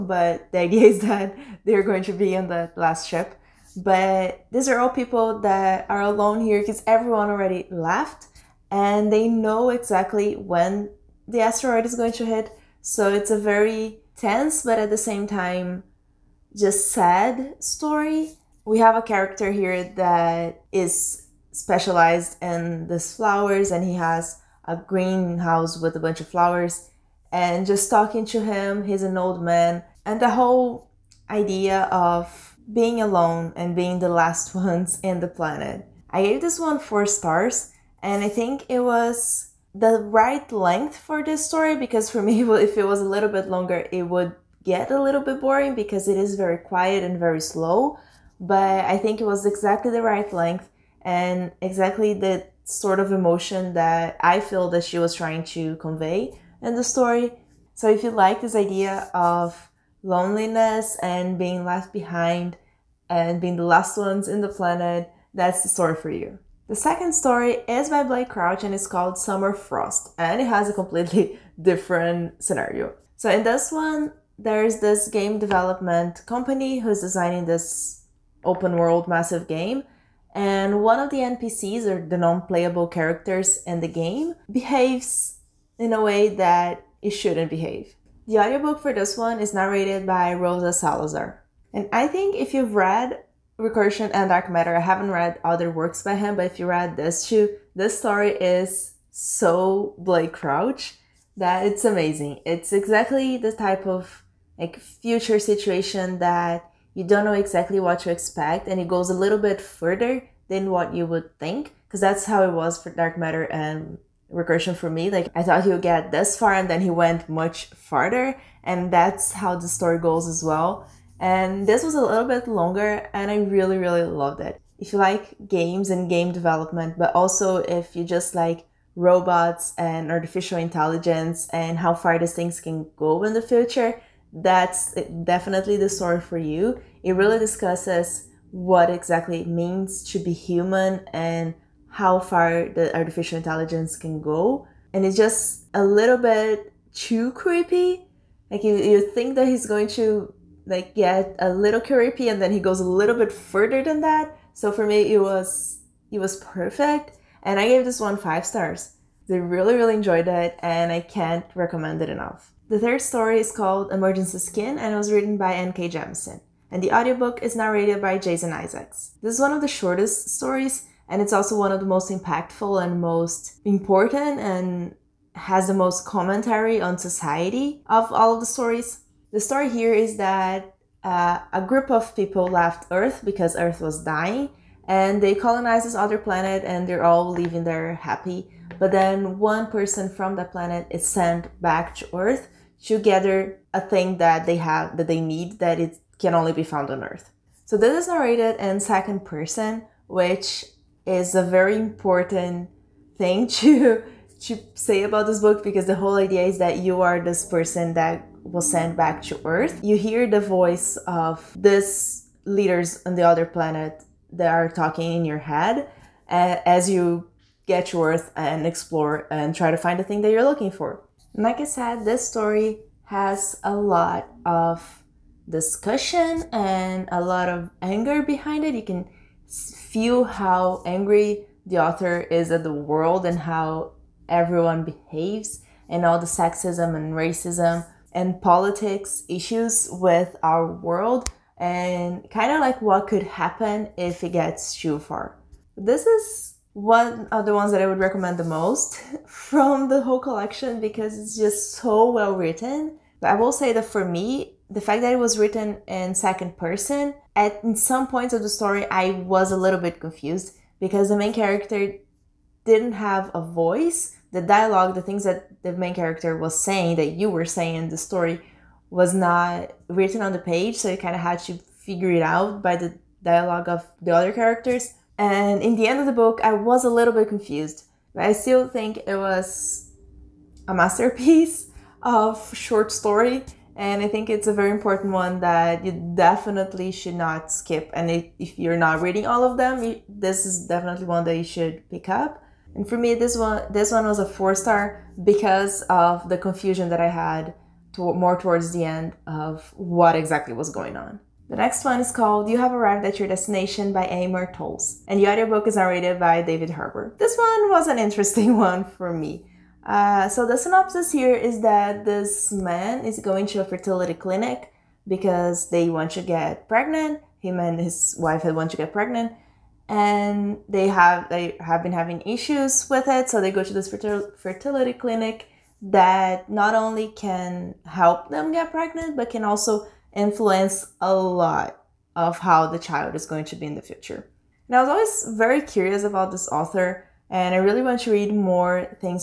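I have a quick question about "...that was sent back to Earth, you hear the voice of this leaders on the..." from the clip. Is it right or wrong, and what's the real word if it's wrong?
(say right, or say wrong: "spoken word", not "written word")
right.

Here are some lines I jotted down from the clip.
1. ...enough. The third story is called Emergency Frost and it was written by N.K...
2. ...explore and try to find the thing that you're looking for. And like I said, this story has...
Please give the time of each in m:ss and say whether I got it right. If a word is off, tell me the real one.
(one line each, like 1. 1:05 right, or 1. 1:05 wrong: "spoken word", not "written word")
1. 2:42 wrong: "Skin", not "Frost"
2. 3:38 right.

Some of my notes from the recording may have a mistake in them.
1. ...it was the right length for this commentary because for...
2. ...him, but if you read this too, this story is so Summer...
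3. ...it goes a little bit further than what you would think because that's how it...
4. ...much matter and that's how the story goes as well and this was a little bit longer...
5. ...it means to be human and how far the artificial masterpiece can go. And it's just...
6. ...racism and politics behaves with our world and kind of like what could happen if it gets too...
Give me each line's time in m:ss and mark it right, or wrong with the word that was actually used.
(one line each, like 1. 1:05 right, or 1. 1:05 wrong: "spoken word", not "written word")
1. 0:38 wrong: "story", not "commentary"
2. 1:36 wrong: "Blake", not "Summer"
3. 1:48 right
4. 1:57 wrong: "farther", not "matter"
5. 2:19 wrong: "intelligence", not "masterpiece"
6. 3:57 wrong: "issues", not "behaves".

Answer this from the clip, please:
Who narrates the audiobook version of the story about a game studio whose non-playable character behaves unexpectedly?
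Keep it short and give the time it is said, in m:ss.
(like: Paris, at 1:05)
Rosa Salazar, at 1:30.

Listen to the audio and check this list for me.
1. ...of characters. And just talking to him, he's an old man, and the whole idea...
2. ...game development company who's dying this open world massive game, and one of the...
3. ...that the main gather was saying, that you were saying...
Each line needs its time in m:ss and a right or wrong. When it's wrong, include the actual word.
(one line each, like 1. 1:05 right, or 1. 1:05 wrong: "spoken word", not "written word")
1. 0:26 wrong: "flowers", not "characters"
2. 1:15 wrong: "designing", not "dying"
3. 4:25 wrong: "character", not "gather".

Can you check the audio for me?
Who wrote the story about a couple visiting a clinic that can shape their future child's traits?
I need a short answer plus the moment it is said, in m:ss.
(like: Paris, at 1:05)
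Amor Towles, at 5:04.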